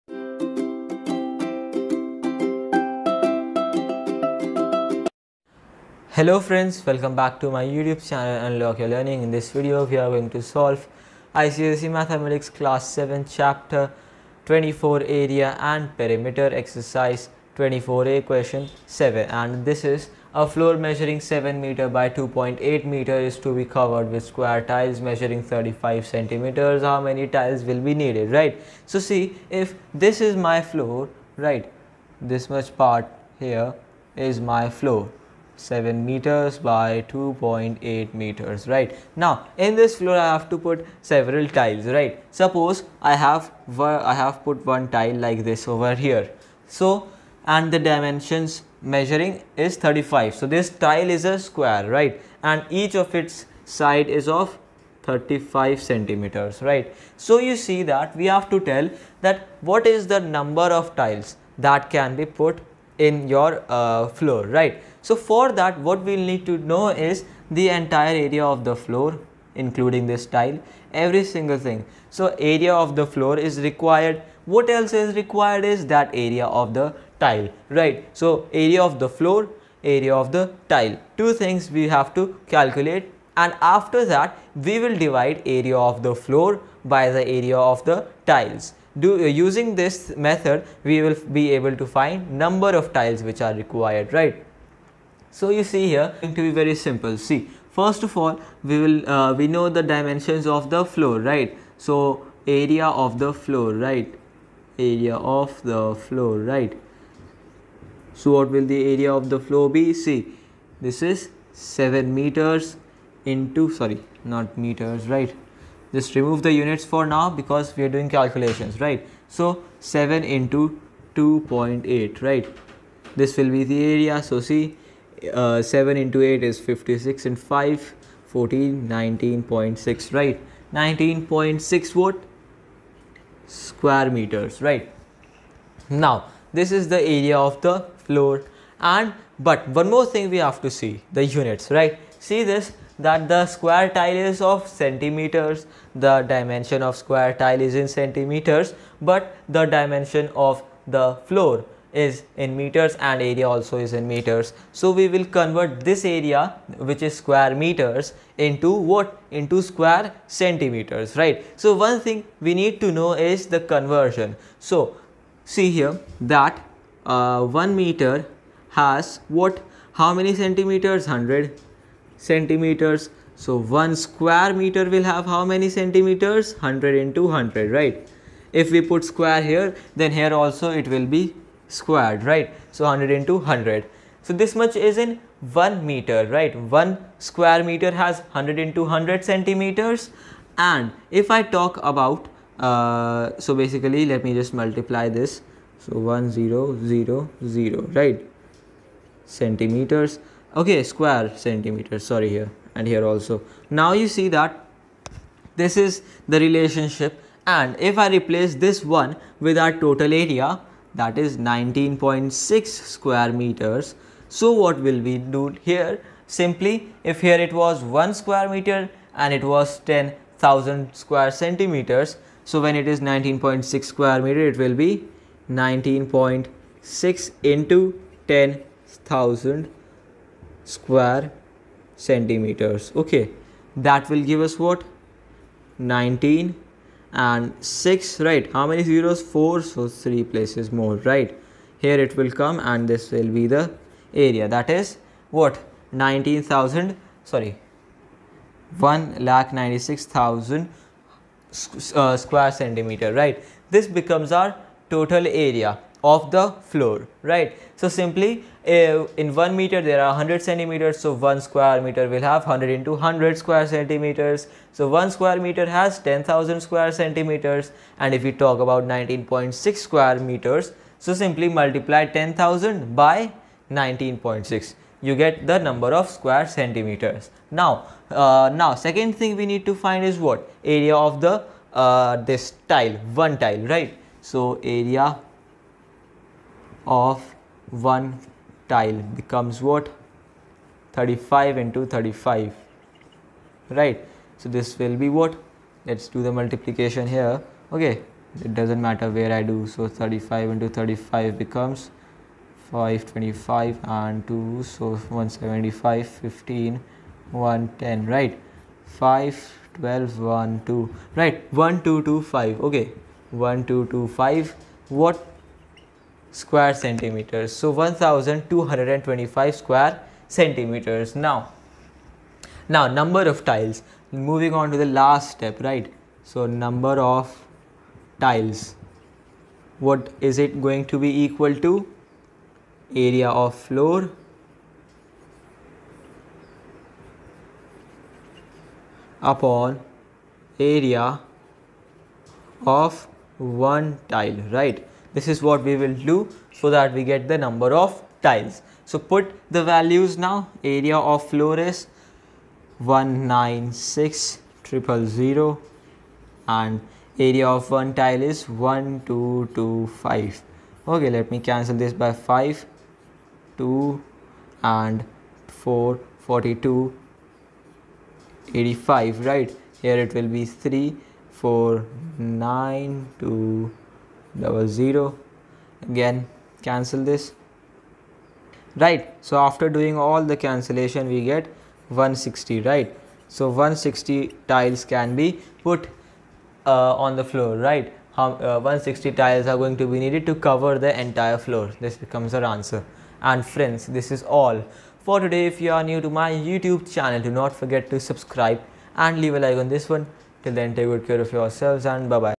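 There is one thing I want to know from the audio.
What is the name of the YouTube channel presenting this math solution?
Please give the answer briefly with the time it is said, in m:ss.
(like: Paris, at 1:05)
Unlock Your Learning, at 0:08.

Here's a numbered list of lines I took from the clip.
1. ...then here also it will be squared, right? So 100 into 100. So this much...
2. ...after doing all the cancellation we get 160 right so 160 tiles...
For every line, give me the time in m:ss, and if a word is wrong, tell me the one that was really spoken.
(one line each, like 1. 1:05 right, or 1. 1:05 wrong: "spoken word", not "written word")
1. 2:59 right
2. 6:19 right.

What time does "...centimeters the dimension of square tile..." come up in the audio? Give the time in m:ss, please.
2:24.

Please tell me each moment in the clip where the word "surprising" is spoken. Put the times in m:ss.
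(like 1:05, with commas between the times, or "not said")
not said.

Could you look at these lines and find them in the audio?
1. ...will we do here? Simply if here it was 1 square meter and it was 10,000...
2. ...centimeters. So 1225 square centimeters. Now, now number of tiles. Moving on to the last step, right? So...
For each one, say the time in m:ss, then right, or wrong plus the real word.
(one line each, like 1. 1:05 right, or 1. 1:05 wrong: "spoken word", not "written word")
1. 3:34 right
2. 5:16 right.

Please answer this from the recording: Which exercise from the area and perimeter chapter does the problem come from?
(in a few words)
24A.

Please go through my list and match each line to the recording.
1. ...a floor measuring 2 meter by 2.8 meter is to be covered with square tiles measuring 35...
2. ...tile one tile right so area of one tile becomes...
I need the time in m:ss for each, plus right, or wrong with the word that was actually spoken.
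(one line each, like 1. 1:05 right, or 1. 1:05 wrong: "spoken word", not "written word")
1. 0:20 wrong: "7", not "2"
2. 4:42 right.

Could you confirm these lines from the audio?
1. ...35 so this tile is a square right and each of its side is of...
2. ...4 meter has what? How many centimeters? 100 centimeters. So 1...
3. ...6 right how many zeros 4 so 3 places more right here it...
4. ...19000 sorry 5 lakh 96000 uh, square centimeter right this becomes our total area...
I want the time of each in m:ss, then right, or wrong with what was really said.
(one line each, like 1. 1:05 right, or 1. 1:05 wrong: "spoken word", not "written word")
1. 0:49 right
2. 2:47 wrong: "1", not "4"
3. 3:57 right
4. 4:05 wrong: "1", not "5".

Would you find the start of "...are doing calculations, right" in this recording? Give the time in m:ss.
1:57.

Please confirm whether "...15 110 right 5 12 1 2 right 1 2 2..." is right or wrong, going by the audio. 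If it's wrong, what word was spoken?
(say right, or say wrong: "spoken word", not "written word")
right.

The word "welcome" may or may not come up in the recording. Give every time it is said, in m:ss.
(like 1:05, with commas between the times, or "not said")
0:06.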